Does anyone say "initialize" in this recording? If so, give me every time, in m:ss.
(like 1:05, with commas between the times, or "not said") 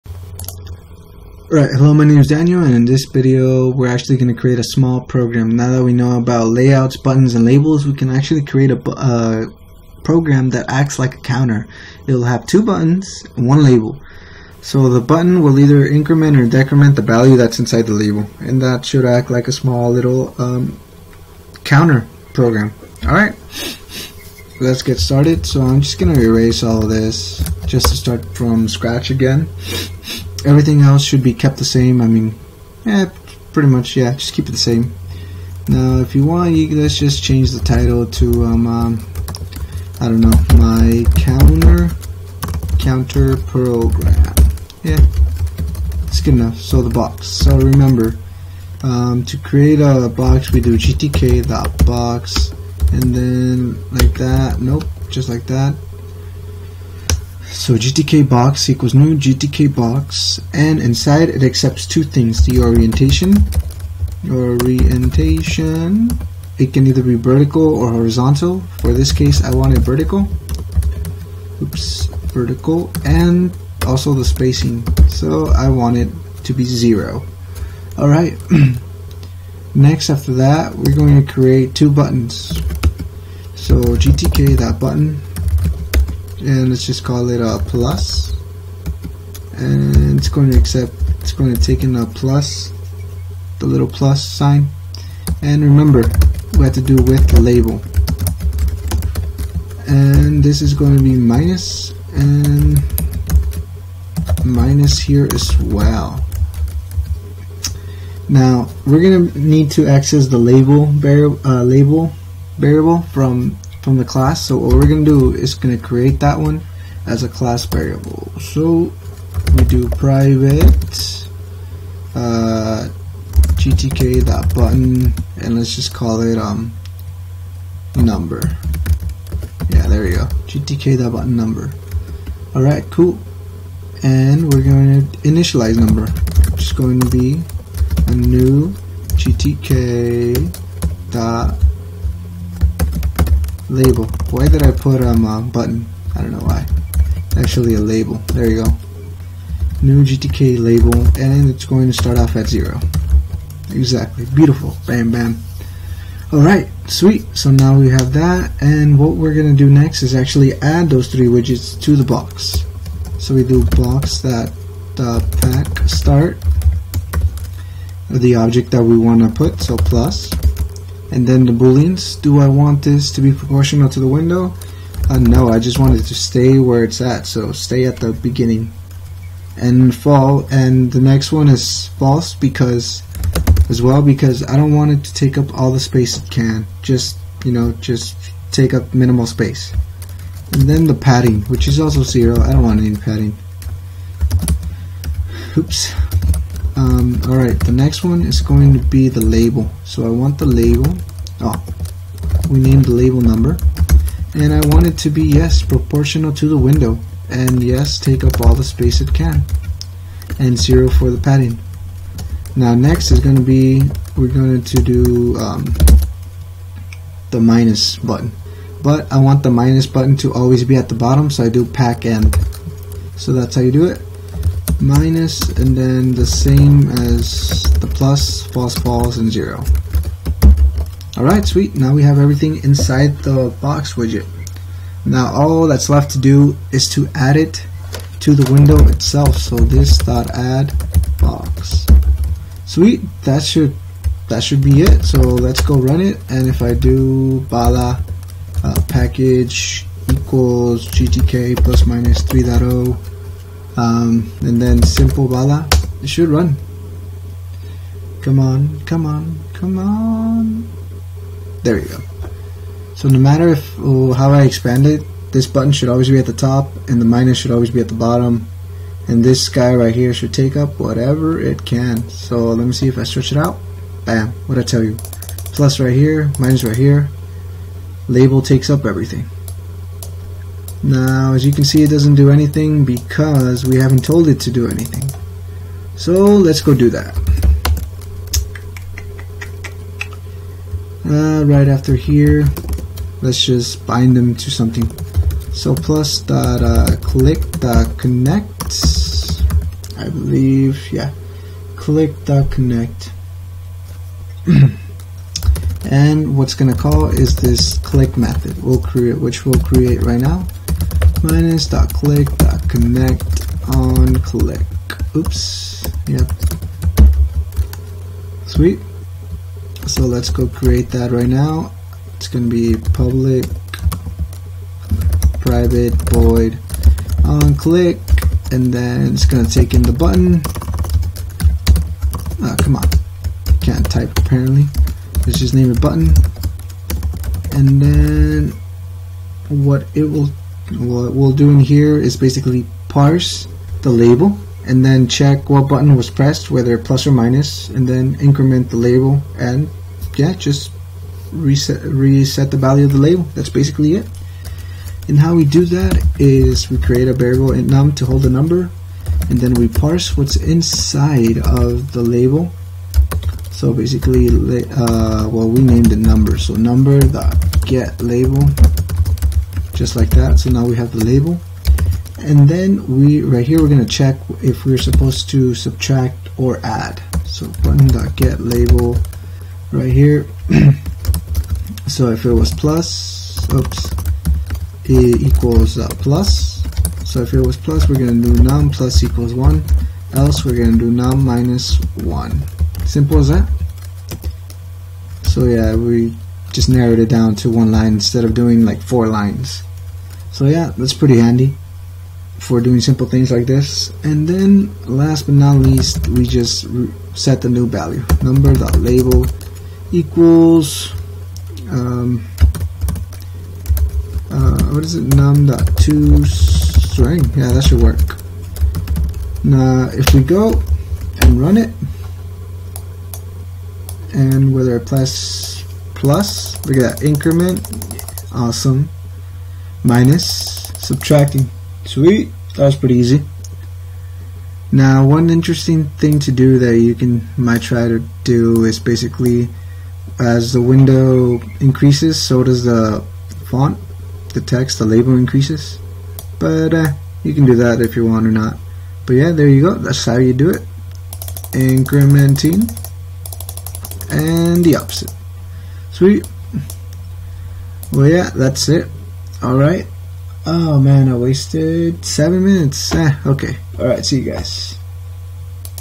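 2:15.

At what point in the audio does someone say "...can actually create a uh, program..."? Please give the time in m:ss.
0:07.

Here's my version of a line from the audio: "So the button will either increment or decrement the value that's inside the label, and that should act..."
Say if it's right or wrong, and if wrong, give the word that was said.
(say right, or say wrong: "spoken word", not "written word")
right.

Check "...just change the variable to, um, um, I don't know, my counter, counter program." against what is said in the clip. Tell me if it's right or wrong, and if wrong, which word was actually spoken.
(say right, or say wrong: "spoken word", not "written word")
wrong: "title", not "variable".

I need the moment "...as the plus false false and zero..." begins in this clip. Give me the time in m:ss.
3:46.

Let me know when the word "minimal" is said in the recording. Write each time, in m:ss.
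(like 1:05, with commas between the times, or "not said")
3:08.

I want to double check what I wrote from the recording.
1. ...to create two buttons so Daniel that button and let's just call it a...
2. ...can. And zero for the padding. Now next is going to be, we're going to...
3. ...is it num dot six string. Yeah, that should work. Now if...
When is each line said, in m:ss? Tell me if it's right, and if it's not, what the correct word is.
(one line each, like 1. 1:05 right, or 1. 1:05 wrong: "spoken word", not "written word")
1. 1:21 wrong: "GTK", not "Daniel"
2. 3:29 right
3. 6:54 wrong: "two", not "six".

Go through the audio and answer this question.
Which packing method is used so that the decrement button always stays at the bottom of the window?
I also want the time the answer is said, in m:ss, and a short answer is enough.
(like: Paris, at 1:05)
pack end, at 3:41.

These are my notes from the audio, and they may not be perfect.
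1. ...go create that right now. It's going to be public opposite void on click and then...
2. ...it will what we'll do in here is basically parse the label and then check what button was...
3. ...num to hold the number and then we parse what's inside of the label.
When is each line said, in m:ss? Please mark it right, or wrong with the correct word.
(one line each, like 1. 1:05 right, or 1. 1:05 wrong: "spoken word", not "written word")
1. 5:20 wrong: "private", not "opposite"
2. 5:39 right
3. 5:57 right.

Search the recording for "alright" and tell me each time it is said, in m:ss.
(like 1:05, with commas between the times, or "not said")
0:23, 1:17, 2:12, 2:36, 3:17, 3:51, 7:39, 7:43.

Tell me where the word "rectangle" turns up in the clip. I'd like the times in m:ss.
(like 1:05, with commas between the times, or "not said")
not said.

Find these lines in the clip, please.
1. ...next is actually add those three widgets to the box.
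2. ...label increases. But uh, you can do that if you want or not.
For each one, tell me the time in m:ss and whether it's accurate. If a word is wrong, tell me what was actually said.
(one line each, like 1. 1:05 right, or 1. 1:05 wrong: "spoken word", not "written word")
1. 2:39 right
2. 7:24 right.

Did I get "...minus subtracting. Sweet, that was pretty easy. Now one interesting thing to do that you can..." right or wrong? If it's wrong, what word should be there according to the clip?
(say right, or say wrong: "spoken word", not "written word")
right.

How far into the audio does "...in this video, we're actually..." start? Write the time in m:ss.
0:02.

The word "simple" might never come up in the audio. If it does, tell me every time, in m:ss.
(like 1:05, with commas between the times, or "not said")
4:14, 6:32, 6:42.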